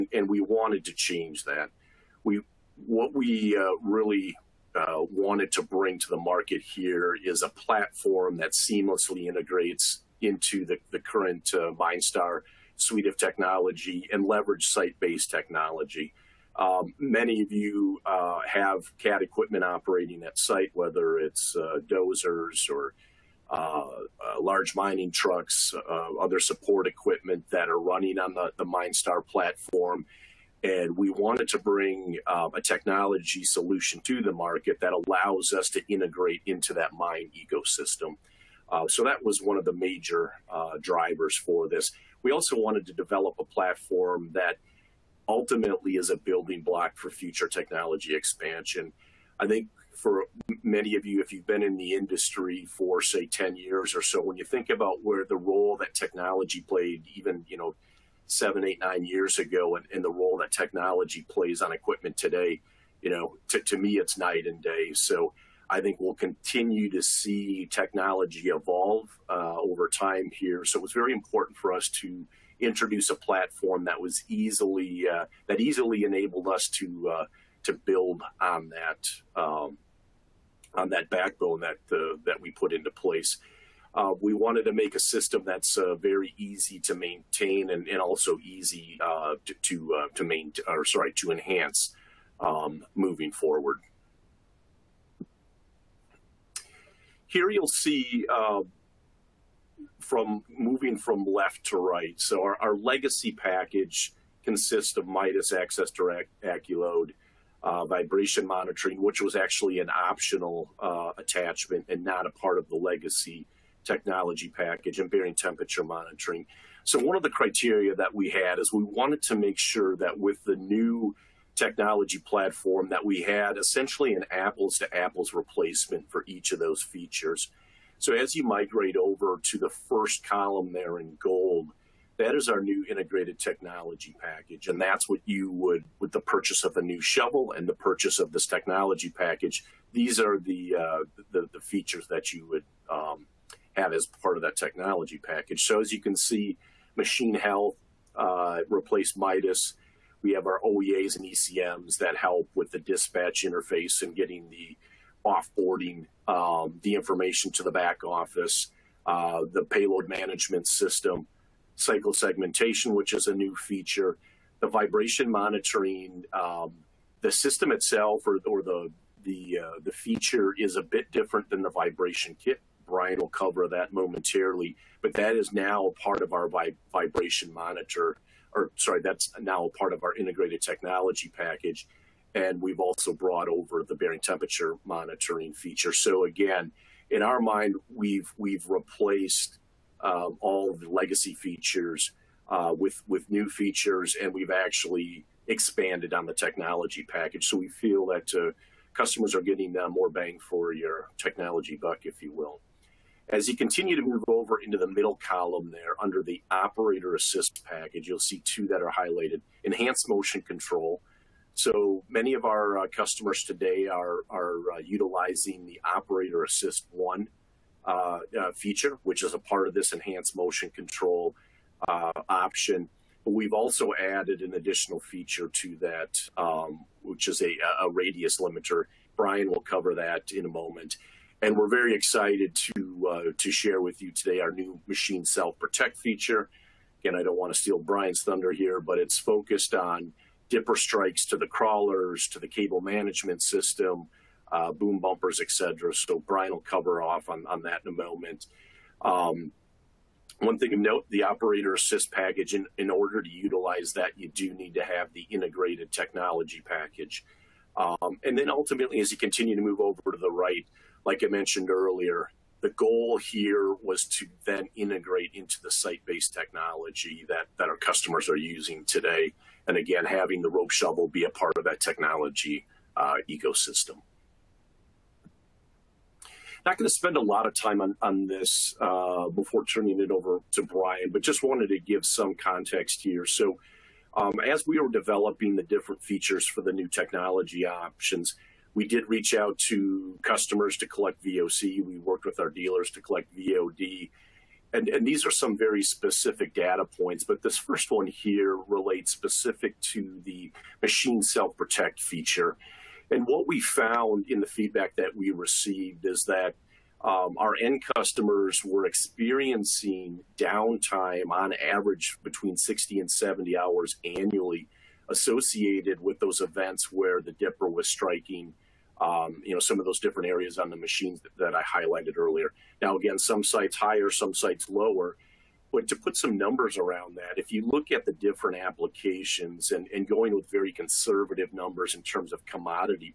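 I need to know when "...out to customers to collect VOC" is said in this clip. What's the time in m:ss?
4:49.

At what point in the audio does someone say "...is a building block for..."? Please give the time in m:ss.
0:45.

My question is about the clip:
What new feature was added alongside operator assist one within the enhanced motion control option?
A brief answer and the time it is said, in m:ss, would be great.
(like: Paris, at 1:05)
radius limiter, at 3:47.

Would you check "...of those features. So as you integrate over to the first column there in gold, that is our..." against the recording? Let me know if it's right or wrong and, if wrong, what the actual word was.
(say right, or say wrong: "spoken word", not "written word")
wrong: "migrate", not "integrate".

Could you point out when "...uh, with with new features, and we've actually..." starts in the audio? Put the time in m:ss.
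3:12.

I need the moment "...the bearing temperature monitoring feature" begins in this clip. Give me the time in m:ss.
3:03.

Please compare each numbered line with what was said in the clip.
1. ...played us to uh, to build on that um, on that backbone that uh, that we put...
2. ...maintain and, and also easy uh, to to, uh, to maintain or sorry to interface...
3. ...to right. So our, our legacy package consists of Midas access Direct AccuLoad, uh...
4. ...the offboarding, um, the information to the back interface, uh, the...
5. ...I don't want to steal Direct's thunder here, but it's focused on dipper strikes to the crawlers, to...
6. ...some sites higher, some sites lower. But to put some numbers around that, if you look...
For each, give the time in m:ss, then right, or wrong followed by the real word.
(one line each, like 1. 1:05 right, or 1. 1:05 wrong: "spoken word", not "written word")
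1. 1:16 wrong: "enabled", not "played"
2. 1:26 wrong: "enhance", not "interface"
3. 1:41 right
4. 2:34 wrong: "office", not "interface"
5. 3:57 wrong: "Brian", not "Direct"
6. 5:23 right.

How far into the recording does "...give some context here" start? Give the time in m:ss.
4:41.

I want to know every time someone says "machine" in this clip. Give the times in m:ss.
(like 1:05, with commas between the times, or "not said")
2:26, 3:54, 5:00, 5:20.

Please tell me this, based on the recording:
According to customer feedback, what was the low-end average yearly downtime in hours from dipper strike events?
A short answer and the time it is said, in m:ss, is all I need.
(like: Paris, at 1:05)
60, at 5:12.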